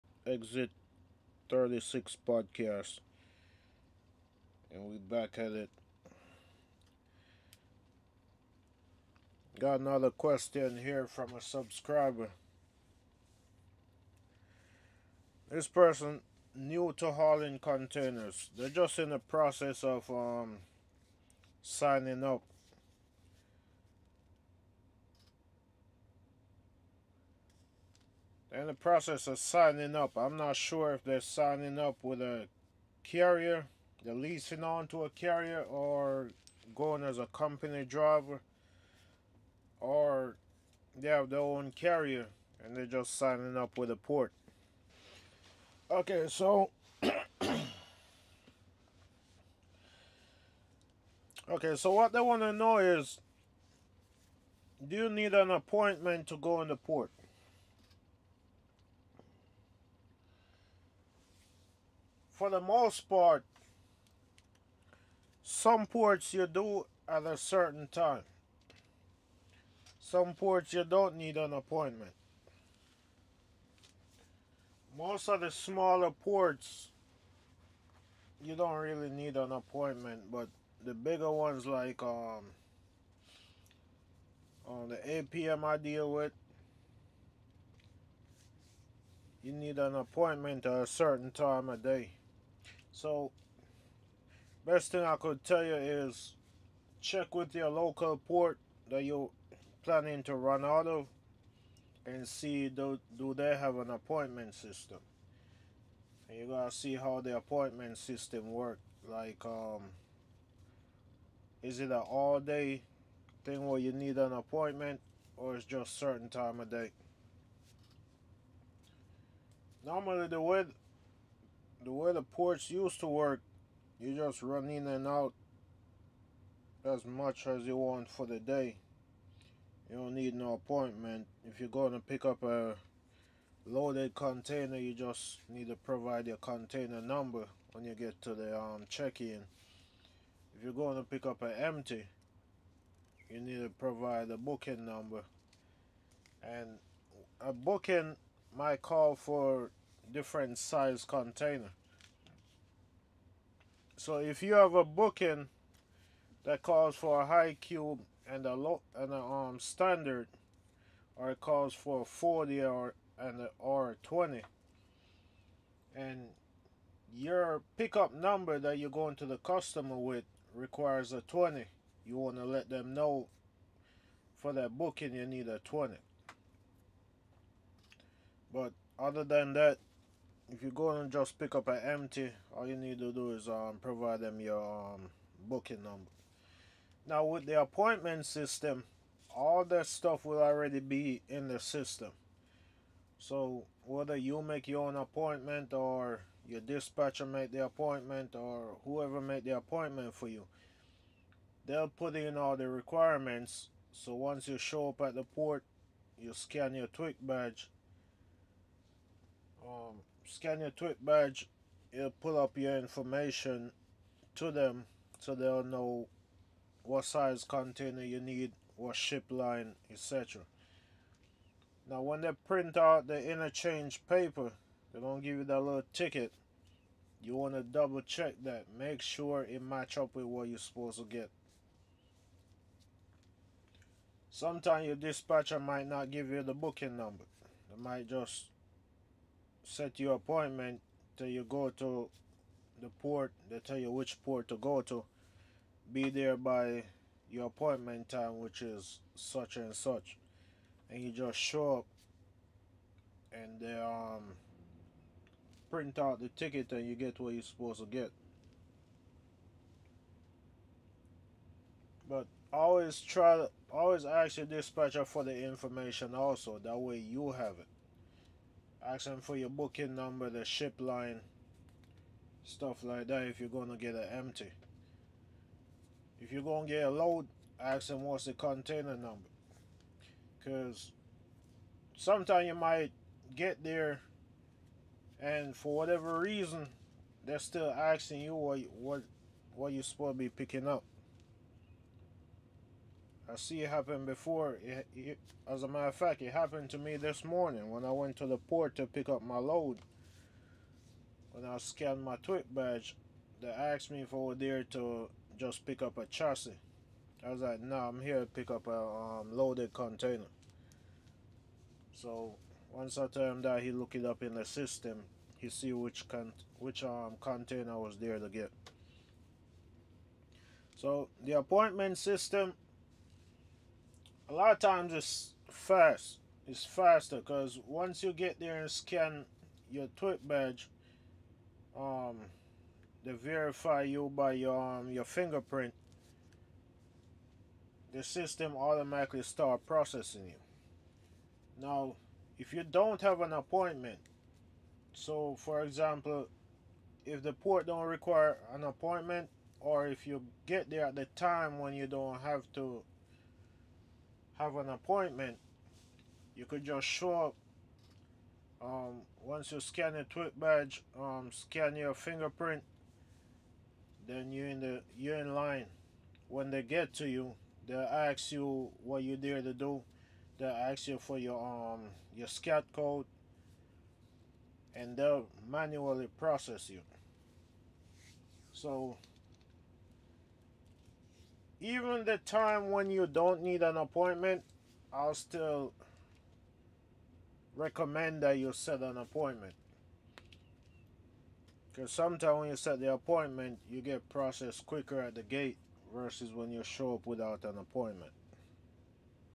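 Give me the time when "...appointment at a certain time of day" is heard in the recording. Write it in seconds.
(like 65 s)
89 s.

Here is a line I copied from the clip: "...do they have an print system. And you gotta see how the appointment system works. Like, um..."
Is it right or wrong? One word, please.
wrong.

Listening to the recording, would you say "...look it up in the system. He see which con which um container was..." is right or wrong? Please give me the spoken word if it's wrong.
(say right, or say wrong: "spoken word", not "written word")
right.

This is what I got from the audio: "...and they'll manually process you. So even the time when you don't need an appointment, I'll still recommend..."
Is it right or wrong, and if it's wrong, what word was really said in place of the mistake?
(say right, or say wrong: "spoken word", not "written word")
right.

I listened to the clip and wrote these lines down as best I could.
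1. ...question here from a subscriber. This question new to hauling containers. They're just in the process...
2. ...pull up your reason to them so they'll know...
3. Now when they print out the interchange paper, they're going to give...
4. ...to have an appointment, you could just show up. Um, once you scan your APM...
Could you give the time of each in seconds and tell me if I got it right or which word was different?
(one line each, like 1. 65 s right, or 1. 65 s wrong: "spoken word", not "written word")
1. 10 s wrong: "person", not "question"
2. 212 s wrong: "information", not "reason"
3. 221 s right
4. 352 s wrong: "TWIC", not "APM".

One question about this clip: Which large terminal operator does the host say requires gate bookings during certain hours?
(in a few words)
APM.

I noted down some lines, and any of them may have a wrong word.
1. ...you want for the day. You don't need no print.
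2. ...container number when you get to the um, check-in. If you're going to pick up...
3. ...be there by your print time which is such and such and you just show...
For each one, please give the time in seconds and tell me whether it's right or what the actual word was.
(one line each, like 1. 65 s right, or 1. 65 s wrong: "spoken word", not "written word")
1. 127 s wrong: "appointment", not "print"
2. 136 s right
3. 245 s wrong: "appointment", not "print".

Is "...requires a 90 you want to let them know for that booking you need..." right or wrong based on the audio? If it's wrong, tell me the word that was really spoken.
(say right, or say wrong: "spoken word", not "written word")
wrong: "20", not "90".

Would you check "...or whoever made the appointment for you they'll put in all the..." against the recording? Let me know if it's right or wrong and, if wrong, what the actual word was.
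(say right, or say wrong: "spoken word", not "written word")
right.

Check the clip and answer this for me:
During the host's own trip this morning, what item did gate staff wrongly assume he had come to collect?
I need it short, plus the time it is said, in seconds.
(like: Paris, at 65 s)
A chassis, at 305 s.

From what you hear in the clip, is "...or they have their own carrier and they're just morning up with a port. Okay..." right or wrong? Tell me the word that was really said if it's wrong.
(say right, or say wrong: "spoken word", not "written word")
wrong: "signing", not "morning".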